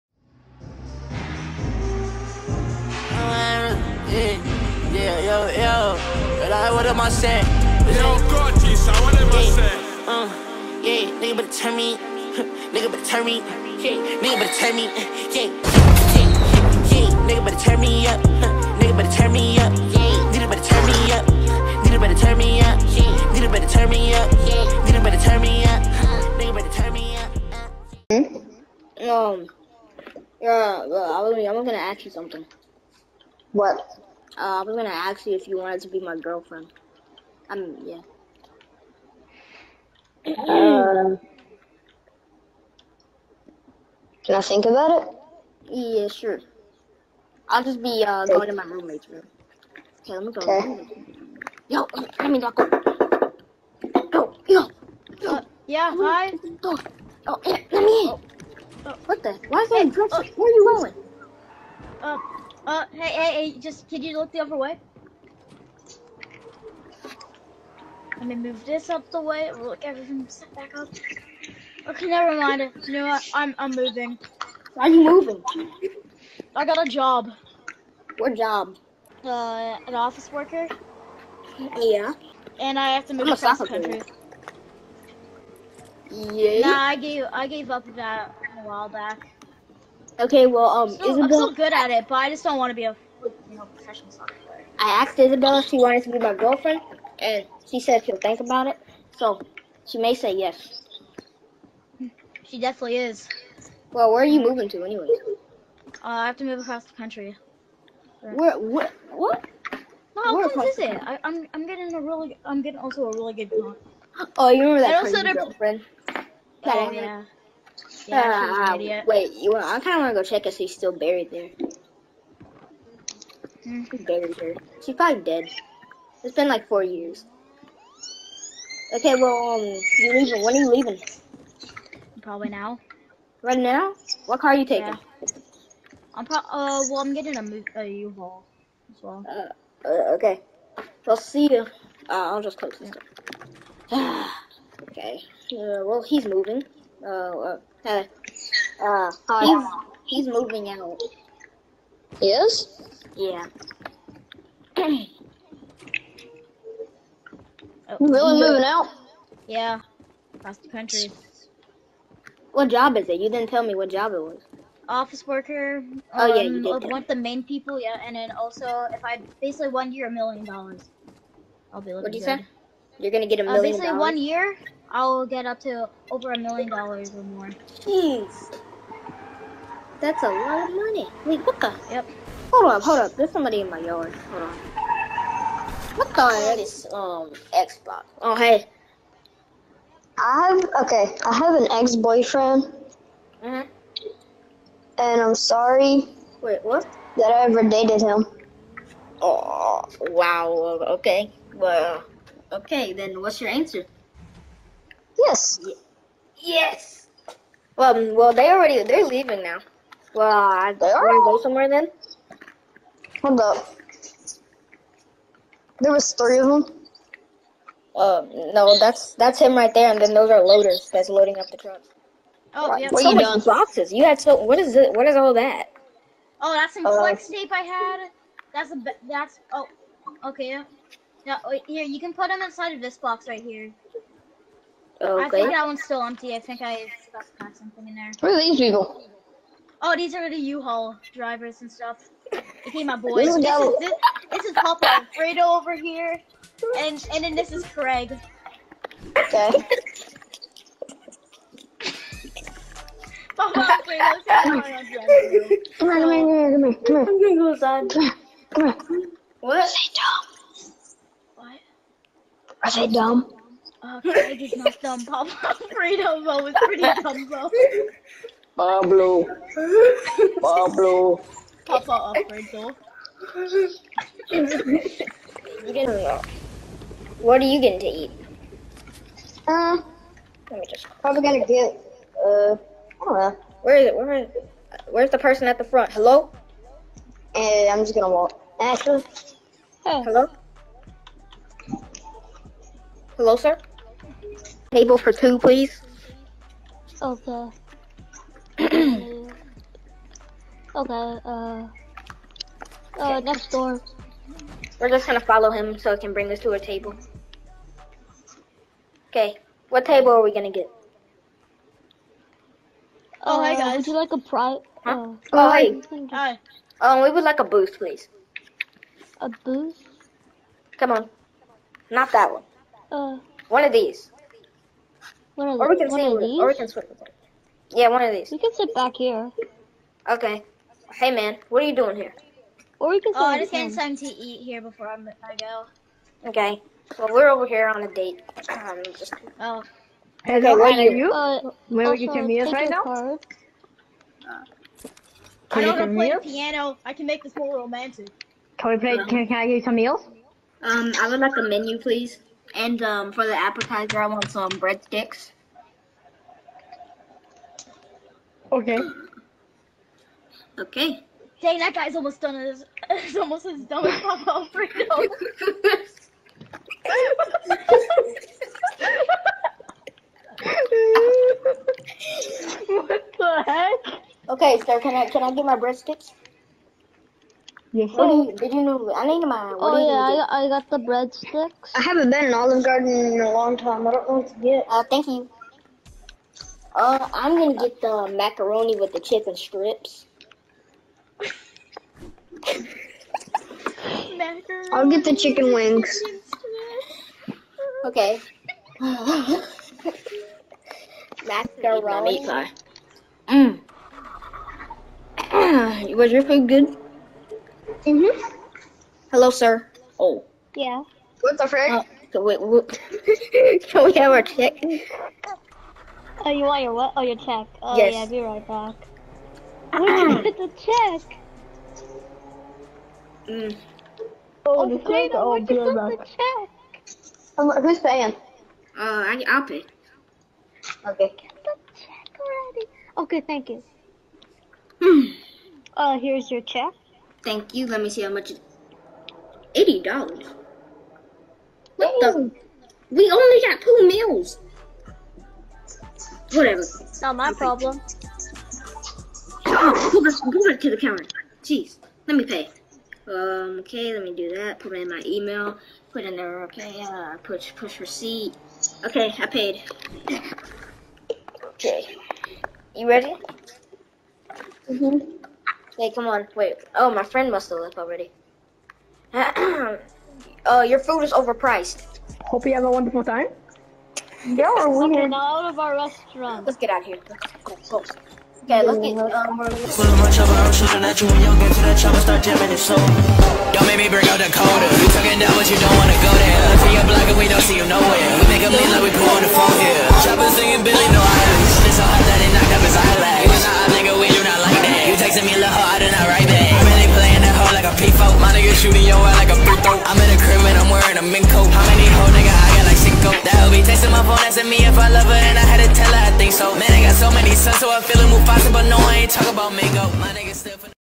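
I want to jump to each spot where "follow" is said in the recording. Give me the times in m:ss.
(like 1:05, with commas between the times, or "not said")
5:05.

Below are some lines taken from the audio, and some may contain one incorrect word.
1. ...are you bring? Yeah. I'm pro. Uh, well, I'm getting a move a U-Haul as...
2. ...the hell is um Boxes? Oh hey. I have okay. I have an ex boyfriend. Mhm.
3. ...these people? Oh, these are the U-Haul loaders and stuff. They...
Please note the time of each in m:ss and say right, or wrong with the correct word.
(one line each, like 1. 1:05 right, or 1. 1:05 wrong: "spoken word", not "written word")
1. 2:14 wrong: "taking", not "bring"
2. 3:06 wrong: "Xbox", not "Boxes"
3. 3:58 wrong: "drivers", not "loaders".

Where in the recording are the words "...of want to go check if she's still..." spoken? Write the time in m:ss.
1:59.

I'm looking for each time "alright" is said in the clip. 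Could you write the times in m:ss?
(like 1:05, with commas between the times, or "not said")
not said.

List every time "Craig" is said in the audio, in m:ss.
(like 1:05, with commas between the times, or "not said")
4:07, 4:23.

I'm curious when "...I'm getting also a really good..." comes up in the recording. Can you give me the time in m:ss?
1:52.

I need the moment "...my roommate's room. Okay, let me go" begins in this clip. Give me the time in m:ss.
0:48.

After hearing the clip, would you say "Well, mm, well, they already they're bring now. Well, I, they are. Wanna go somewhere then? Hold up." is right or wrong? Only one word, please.
wrong.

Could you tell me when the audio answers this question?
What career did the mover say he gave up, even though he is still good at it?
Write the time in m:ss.
1:33.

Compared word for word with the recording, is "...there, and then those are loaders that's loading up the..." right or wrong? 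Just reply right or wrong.
right.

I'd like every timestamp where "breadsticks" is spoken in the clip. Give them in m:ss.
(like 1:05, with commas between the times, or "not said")
5:54, 6:15, 6:20.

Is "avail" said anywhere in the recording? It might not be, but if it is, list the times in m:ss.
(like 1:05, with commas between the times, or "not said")
not said.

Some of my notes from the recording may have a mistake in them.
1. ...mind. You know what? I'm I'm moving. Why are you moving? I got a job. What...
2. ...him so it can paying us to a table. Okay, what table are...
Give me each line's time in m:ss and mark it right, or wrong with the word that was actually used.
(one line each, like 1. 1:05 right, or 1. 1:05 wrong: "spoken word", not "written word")
1. 1:12 right
2. 5:05 wrong: "bring", not "paying".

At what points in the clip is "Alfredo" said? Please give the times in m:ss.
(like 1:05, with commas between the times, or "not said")
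4:04, 4:13, 4:25, 4:32, 6:04.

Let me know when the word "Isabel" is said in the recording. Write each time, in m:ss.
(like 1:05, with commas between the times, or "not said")
1:31, 1:35.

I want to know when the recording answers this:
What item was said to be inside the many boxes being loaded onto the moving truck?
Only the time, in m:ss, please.
3:46.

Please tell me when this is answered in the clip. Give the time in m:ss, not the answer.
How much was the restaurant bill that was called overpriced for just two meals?
7:19.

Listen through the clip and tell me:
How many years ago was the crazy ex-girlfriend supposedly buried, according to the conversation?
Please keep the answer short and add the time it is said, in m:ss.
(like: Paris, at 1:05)
4 years, at 2:06.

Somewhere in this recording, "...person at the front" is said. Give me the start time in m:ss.
4:45.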